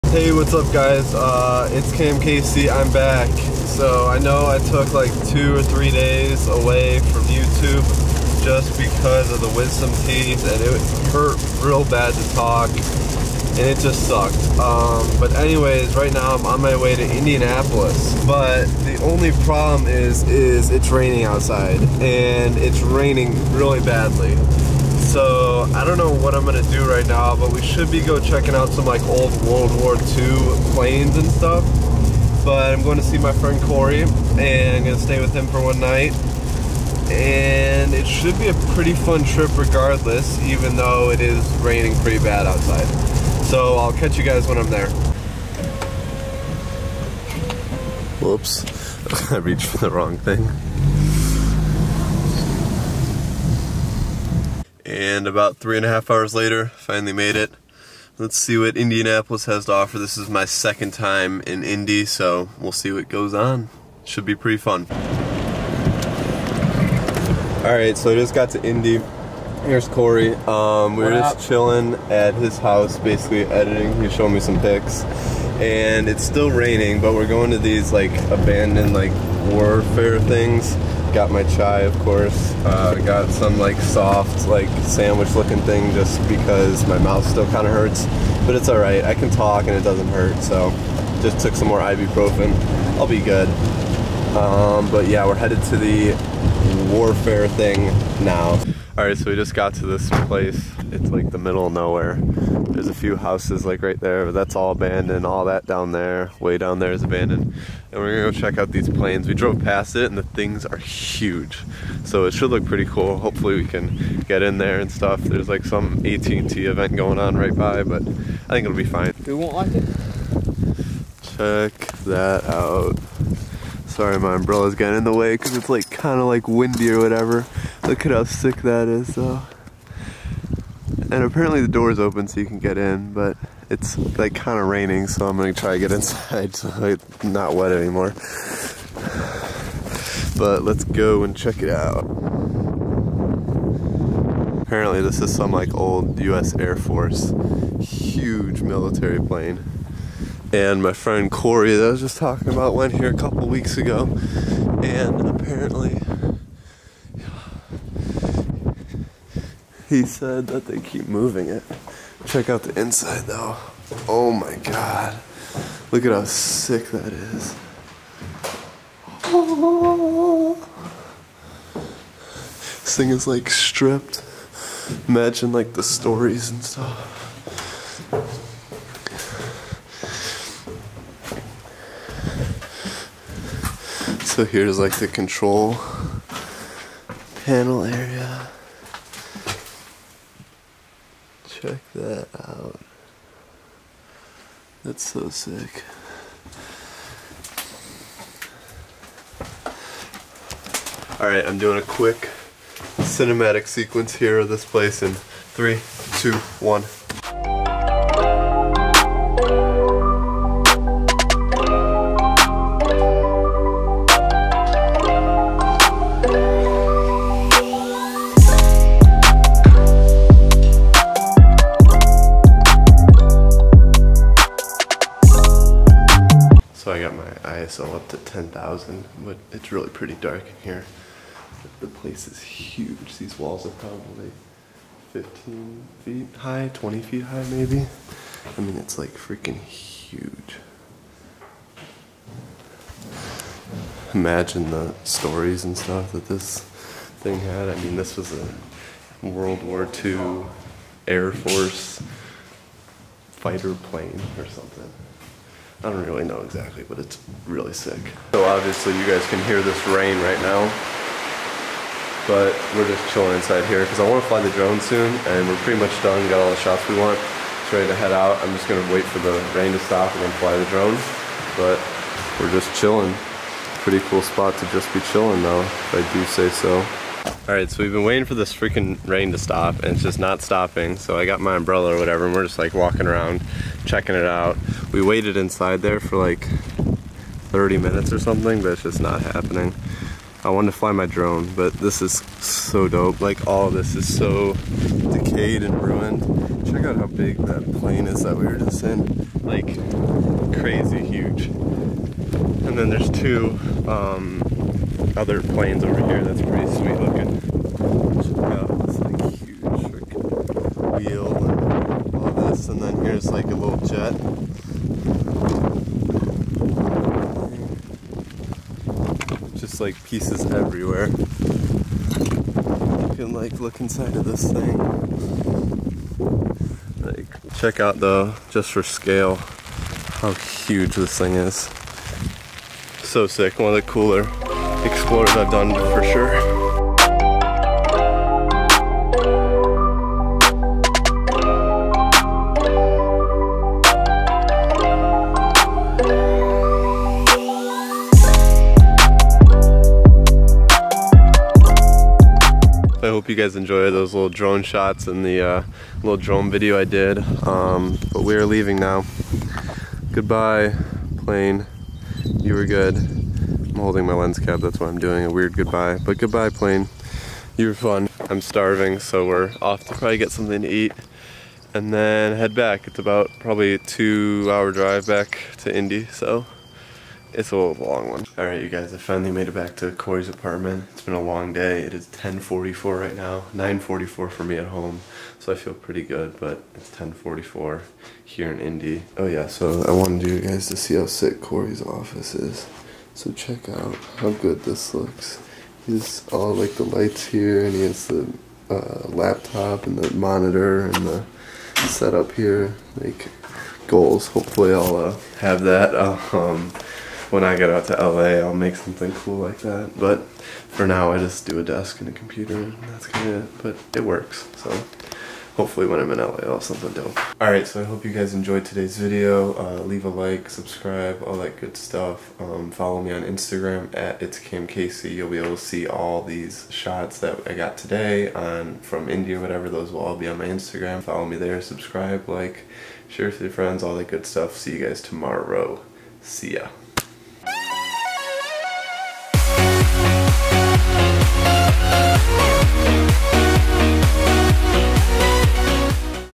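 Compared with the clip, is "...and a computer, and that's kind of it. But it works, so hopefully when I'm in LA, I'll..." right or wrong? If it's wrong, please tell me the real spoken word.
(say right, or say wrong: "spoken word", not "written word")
right.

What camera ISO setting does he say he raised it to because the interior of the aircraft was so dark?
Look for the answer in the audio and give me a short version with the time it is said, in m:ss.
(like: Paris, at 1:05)
10,000, at 3:48.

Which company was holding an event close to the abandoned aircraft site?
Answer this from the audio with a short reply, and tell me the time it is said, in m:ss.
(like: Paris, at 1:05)
AT&T, at 1:56.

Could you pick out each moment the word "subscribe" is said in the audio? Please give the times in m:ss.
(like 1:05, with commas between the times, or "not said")
7:00, 7:11.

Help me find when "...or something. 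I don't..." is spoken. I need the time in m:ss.
4:14.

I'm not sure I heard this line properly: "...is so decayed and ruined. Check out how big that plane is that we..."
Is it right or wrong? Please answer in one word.
right.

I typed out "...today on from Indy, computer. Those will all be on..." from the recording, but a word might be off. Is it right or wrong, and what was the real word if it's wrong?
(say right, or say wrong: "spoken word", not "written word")
wrong: "whatever", not "computer".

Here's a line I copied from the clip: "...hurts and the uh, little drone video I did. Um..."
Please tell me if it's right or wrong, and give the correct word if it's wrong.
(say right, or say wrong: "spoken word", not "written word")
wrong: "shots", not "hurts".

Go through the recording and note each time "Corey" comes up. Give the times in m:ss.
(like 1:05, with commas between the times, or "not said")
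0:33, 1:09, 2:31, 6:19, 6:31.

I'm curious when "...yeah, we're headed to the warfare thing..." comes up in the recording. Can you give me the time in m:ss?
1:35.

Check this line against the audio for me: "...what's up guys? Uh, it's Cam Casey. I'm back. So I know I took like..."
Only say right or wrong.
right.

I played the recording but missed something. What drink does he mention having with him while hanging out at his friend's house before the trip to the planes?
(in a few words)
Chai.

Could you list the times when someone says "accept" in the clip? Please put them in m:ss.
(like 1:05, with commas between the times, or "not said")
not said.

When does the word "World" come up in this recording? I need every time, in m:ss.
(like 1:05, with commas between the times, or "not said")
0:29, 4:09.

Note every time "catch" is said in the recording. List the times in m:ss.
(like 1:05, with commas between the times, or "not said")
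0:43.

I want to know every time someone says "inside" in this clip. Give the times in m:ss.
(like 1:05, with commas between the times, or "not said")
2:15, 2:42, 4:23, 4:45, 5:23.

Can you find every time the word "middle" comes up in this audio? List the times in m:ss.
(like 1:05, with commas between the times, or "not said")
1:41.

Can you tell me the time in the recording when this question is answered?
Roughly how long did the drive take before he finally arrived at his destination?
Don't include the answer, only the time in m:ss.
0:55.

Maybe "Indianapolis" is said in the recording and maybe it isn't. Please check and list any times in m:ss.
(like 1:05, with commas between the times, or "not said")
0:17, 0:58.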